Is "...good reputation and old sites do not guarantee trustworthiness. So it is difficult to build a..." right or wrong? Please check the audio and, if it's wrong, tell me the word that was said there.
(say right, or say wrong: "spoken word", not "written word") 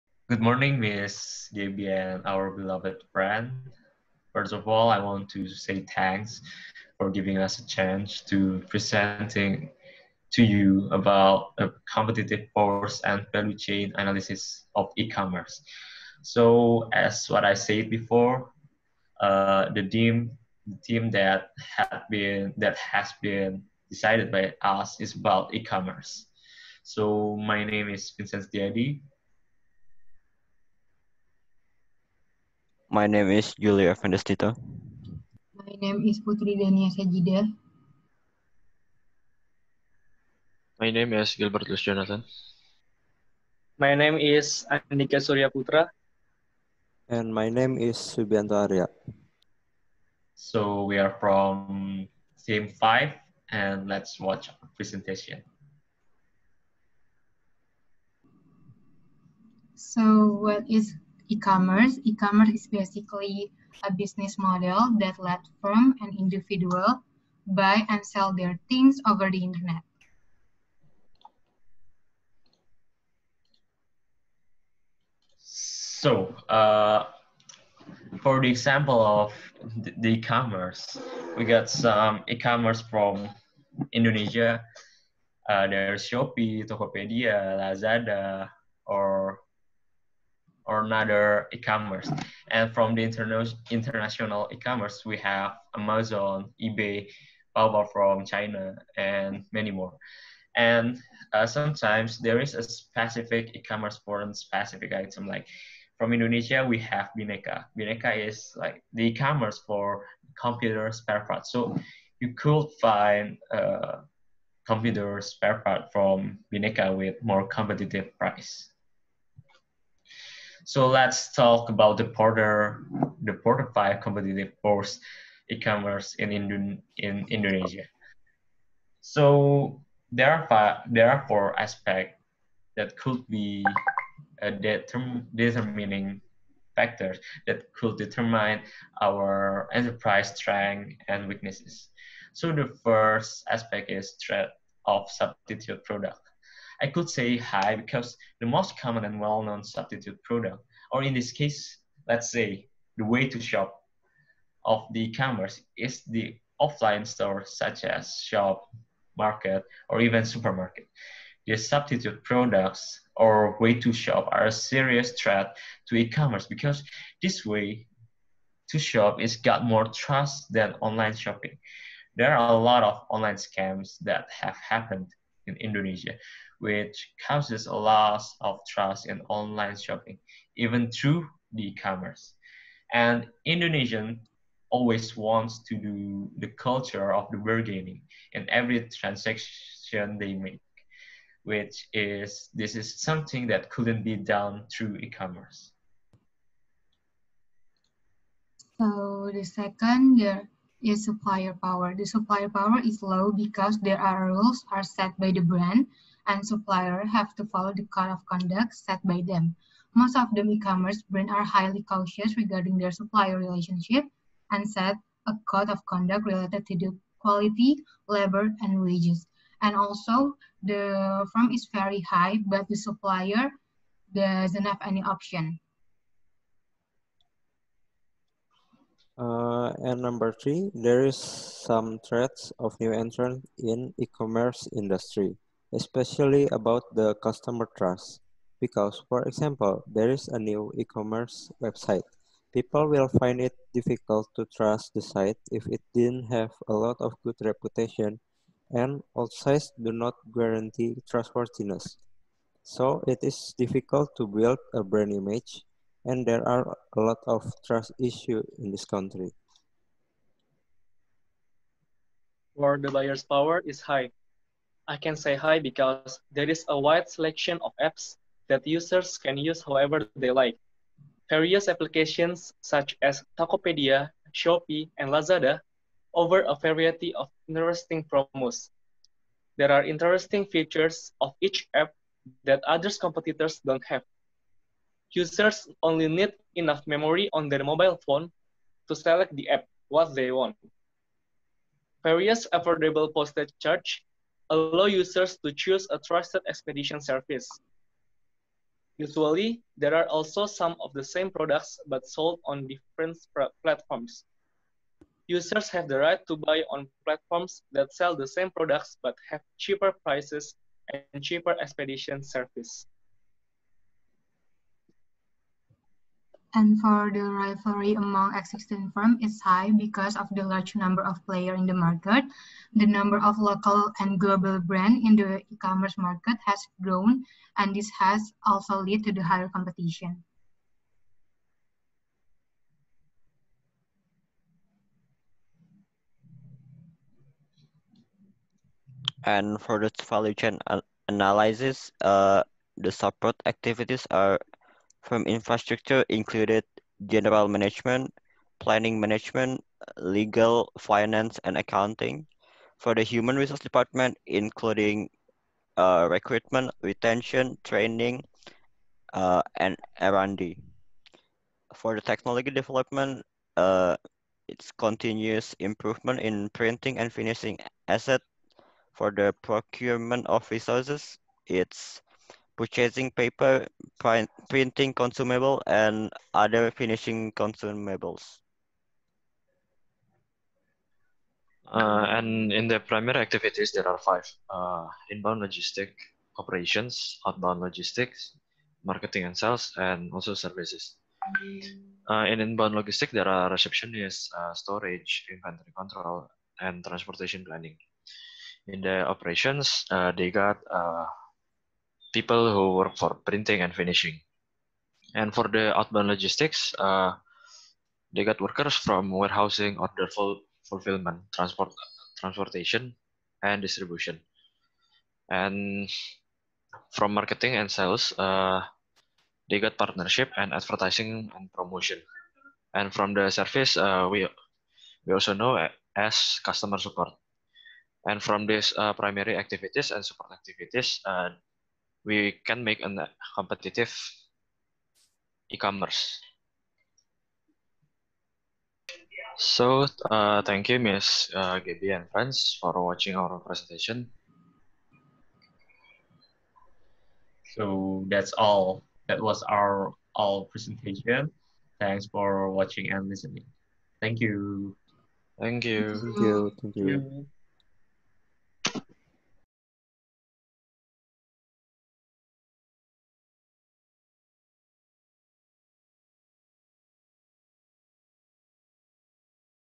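right.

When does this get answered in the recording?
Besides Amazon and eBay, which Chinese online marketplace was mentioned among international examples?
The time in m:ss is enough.
1:37.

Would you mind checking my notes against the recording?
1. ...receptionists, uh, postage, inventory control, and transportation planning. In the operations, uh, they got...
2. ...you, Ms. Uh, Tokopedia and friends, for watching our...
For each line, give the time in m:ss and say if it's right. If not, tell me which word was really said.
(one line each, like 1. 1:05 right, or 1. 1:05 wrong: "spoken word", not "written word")
1. 6:33 wrong: "storage", not "postage"
2. 7:20 wrong: "Gabby", not "Tokopedia".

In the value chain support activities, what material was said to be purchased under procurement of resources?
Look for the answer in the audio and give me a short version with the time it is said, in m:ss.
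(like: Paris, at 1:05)
paper, at 6:13.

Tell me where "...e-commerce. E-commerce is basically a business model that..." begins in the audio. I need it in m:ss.
1:01.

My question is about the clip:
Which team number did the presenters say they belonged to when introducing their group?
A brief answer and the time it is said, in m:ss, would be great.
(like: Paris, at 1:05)
Team 5, at 0:52.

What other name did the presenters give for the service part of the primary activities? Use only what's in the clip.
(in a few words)
customer support.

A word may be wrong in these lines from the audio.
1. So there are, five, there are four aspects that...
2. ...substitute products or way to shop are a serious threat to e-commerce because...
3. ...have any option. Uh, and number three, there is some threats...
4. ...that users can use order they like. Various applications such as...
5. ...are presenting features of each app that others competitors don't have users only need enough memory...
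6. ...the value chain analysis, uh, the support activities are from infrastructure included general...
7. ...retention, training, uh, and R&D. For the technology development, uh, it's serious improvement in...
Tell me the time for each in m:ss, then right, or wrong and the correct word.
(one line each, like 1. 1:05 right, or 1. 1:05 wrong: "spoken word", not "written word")
1. 2:09 right
2. 2:41 right
3. 3:44 right
4. 4:28 wrong: "however", not "order"
5. 4:39 wrong: "interesting", not "presenting"
6. 5:39 right
7. 5:56 wrong: "continuous", not "serious".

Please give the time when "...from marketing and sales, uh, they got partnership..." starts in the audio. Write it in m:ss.
6:56.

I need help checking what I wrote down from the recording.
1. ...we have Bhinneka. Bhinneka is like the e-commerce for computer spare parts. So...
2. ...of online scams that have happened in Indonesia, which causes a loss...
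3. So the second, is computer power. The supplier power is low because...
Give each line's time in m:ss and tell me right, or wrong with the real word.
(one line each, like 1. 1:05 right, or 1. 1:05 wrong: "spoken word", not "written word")
1. 1:46 right
2. 2:52 right
3. 3:18 wrong: "supplier", not "computer".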